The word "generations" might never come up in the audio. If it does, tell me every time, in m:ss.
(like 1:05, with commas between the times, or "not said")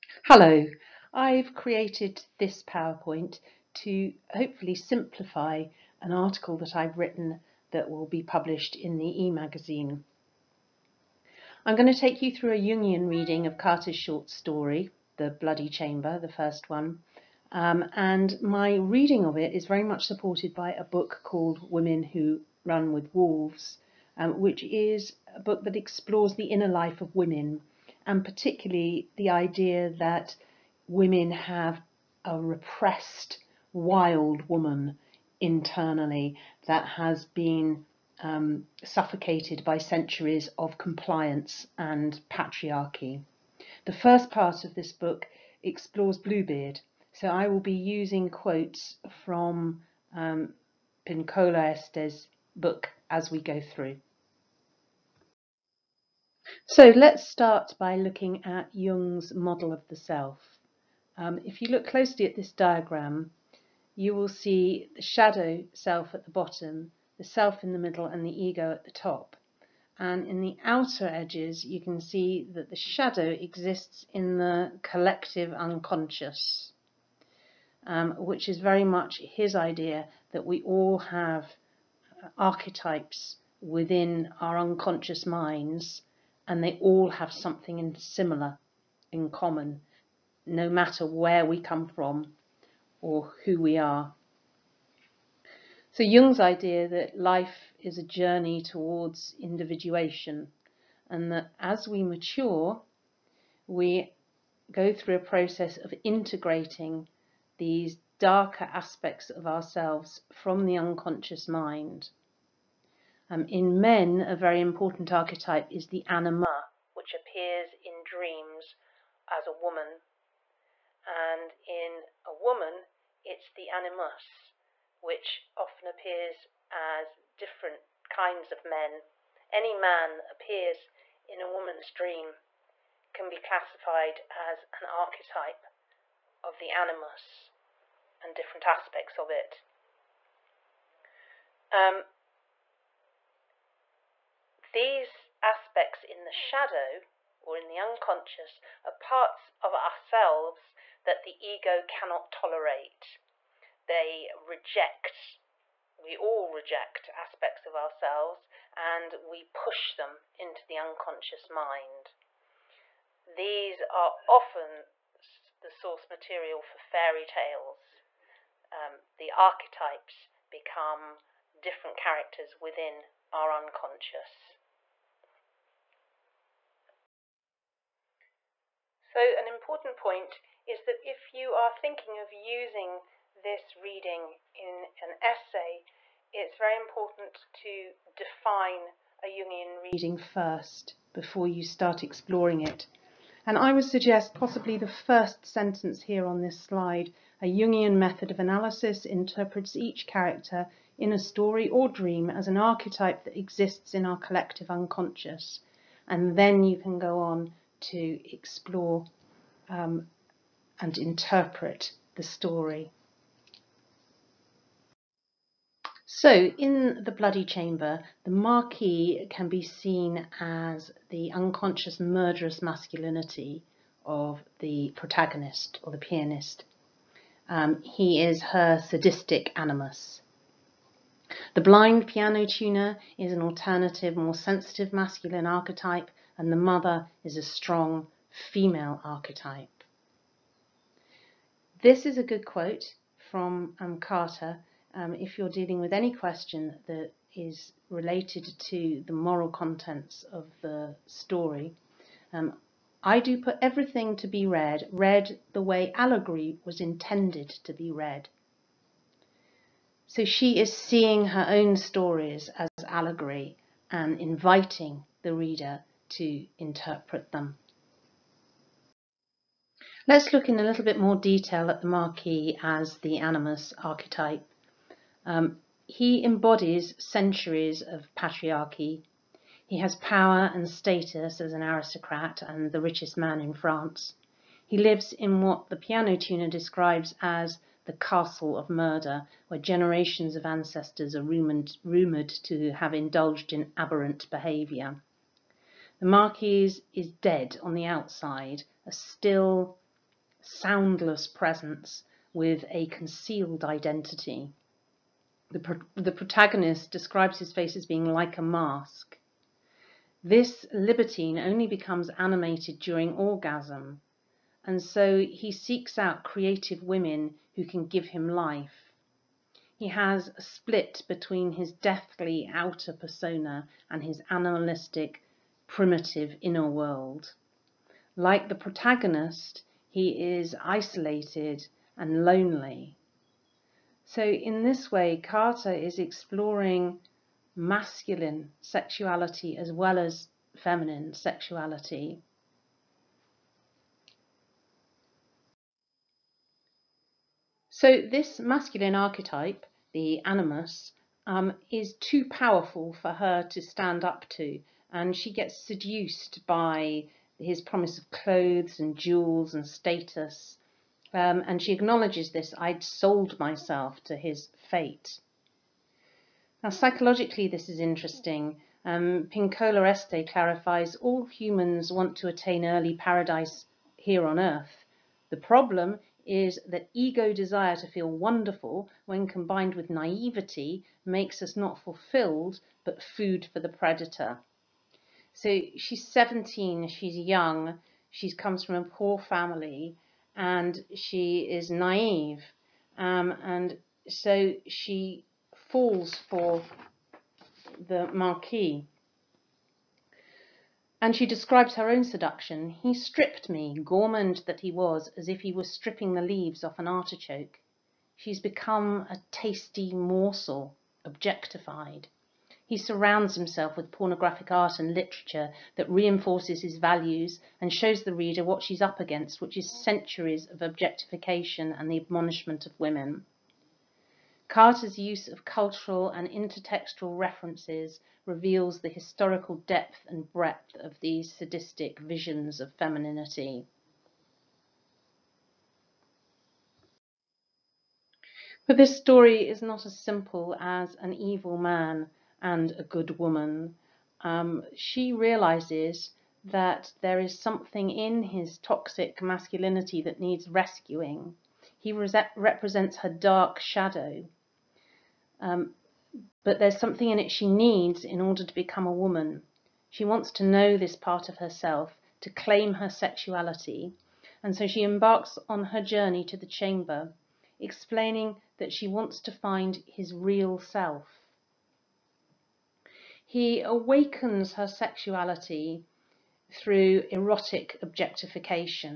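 4:49.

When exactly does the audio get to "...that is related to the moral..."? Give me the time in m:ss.
4:06.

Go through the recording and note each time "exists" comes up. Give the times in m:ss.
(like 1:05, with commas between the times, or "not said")
1:13, 3:23.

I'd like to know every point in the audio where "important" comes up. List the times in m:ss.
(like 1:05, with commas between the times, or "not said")
1:54, 2:59, 3:06.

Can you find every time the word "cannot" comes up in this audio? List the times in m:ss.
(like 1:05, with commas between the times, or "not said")
2:31.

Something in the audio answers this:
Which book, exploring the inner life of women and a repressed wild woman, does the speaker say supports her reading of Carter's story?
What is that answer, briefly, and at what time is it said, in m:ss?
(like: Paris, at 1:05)
Women Who Run With Wolves, at 0:21.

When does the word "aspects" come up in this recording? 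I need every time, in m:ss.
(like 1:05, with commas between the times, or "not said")
1:48, 2:18, 2:25, 2:37.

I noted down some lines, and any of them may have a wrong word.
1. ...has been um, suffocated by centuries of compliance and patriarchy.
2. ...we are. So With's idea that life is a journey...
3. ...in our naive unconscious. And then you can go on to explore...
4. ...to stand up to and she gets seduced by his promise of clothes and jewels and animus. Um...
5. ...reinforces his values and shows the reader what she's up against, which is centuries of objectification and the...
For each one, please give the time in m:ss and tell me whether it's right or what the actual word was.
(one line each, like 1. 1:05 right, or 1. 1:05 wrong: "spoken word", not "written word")
1. 0:36 right
2. 1:33 wrong: "Jung", not "With"
3. 3:23 wrong: "collective", not "naive"
4. 5:53 wrong: "status", not "animus"
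5. 6:55 right.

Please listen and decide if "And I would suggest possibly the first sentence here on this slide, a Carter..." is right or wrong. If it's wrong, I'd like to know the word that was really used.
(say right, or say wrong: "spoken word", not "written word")
wrong: "Jungian", not "Carter".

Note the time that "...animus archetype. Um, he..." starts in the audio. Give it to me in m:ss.
4:33.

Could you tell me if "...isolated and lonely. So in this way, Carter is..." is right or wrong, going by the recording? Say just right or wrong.
right.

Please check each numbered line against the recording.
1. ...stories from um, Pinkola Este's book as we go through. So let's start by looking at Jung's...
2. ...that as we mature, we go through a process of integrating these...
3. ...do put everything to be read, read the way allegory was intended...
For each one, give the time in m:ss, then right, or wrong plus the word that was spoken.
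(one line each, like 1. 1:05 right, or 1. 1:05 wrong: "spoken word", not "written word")
1. 0:48 wrong: "quotes", not "stories"
2. 1:41 right
3. 4:13 right.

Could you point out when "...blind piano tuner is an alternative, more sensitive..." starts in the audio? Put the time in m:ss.
3:51.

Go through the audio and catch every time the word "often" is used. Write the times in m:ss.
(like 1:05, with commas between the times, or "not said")
2:05, 2:44.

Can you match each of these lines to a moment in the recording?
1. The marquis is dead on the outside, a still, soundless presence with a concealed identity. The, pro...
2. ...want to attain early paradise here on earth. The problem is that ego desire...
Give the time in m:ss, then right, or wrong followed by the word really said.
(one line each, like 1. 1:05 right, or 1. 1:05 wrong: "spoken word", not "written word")
1. 4:55 right
2. 6:11 right.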